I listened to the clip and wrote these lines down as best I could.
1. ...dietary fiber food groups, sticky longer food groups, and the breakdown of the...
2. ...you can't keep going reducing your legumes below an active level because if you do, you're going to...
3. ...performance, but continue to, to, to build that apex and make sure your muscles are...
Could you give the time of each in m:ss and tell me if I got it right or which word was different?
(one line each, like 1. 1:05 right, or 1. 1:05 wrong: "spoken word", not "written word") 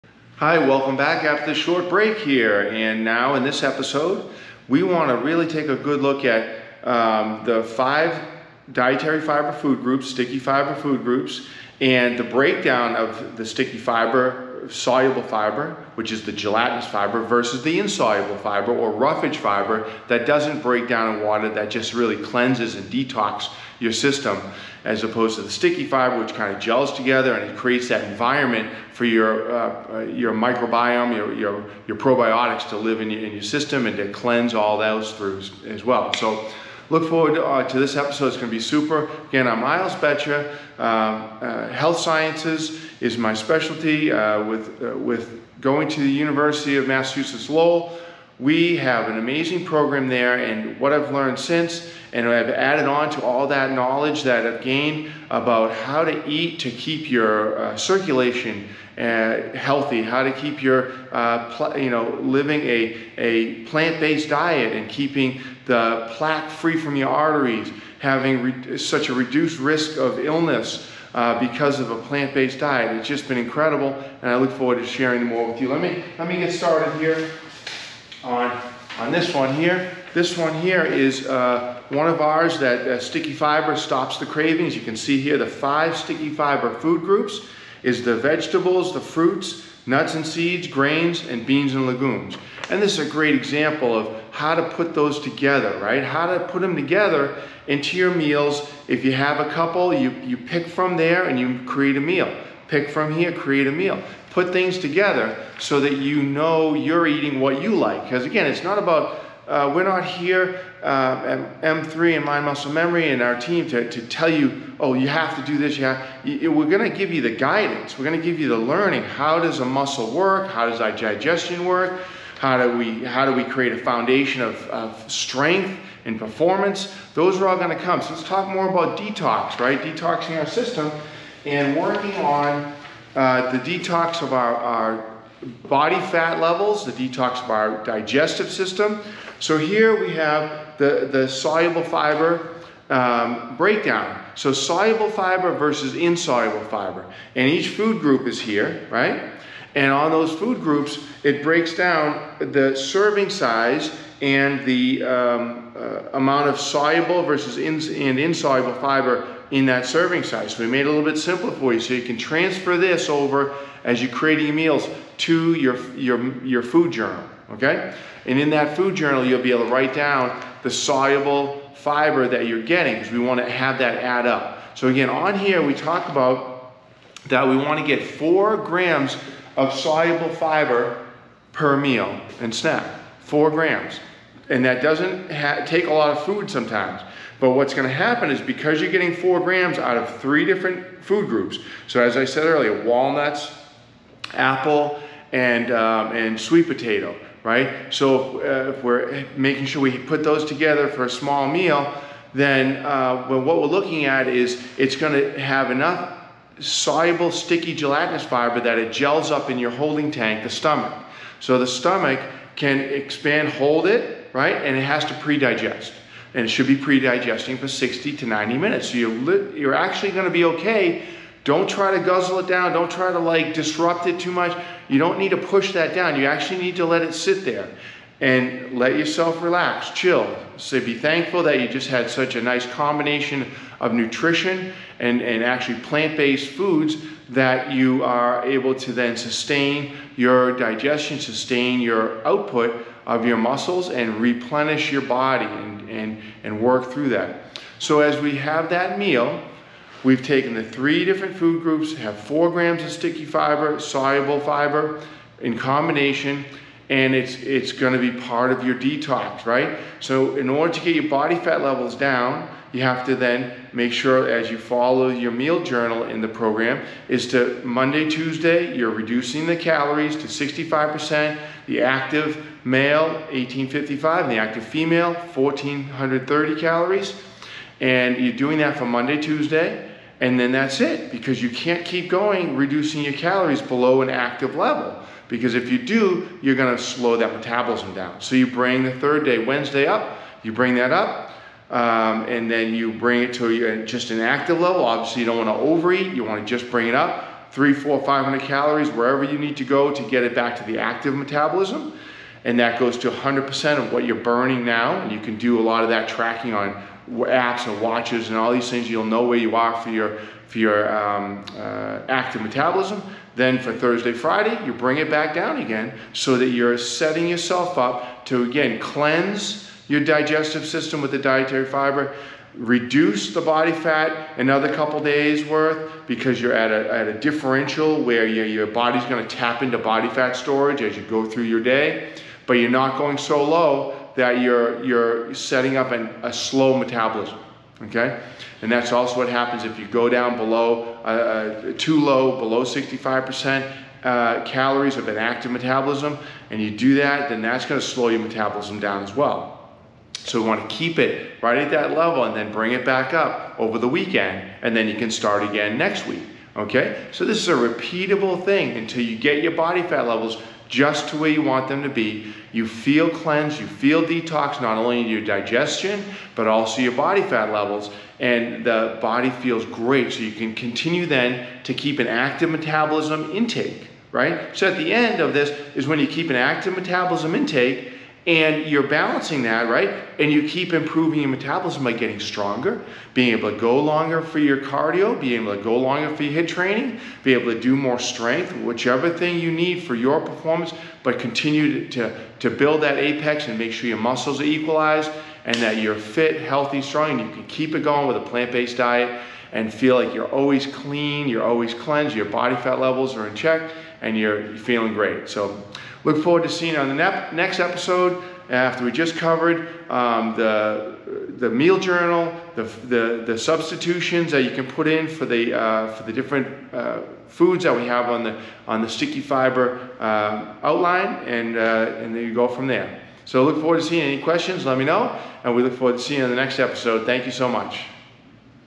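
1. 0:08 wrong: "fiber", not "longer"
2. 4:41 wrong: "calories", not "legumes"
3. 6:30 right.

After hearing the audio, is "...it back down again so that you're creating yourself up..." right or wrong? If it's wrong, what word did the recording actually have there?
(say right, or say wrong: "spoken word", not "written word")
wrong: "setting", not "creating".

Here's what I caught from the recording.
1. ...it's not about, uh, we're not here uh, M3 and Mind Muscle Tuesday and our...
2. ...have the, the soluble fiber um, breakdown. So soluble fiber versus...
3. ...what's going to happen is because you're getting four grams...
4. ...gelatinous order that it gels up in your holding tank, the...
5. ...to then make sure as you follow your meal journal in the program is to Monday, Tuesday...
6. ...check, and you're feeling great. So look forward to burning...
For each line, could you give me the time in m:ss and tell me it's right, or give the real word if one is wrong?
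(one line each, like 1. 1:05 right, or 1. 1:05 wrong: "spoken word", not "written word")
1. 1:48 wrong: "Memory", not "Tuesday"
2. 2:20 right
3. 3:07 right
4. 3:27 wrong: "fiber", not "order"
5. 4:23 right
6. 6:43 wrong: "seeing", not "burning".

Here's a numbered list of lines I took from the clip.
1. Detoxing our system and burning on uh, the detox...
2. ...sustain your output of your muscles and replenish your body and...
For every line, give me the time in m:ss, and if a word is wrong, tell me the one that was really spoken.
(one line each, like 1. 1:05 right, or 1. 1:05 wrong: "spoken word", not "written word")
1. 2:09 wrong: "working", not "burning"
2. 4:01 right.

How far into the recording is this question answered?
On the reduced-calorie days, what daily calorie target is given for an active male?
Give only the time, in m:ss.
4:33.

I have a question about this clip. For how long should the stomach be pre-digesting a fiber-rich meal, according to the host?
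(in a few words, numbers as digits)
60 to 90 minutes.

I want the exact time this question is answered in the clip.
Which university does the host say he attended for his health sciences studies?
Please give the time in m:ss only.
0:46.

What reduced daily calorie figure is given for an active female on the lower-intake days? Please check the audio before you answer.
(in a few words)
1430.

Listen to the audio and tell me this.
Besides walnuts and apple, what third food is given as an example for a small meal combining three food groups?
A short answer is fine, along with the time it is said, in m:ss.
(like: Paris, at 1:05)
Sweet potato, at 3:16.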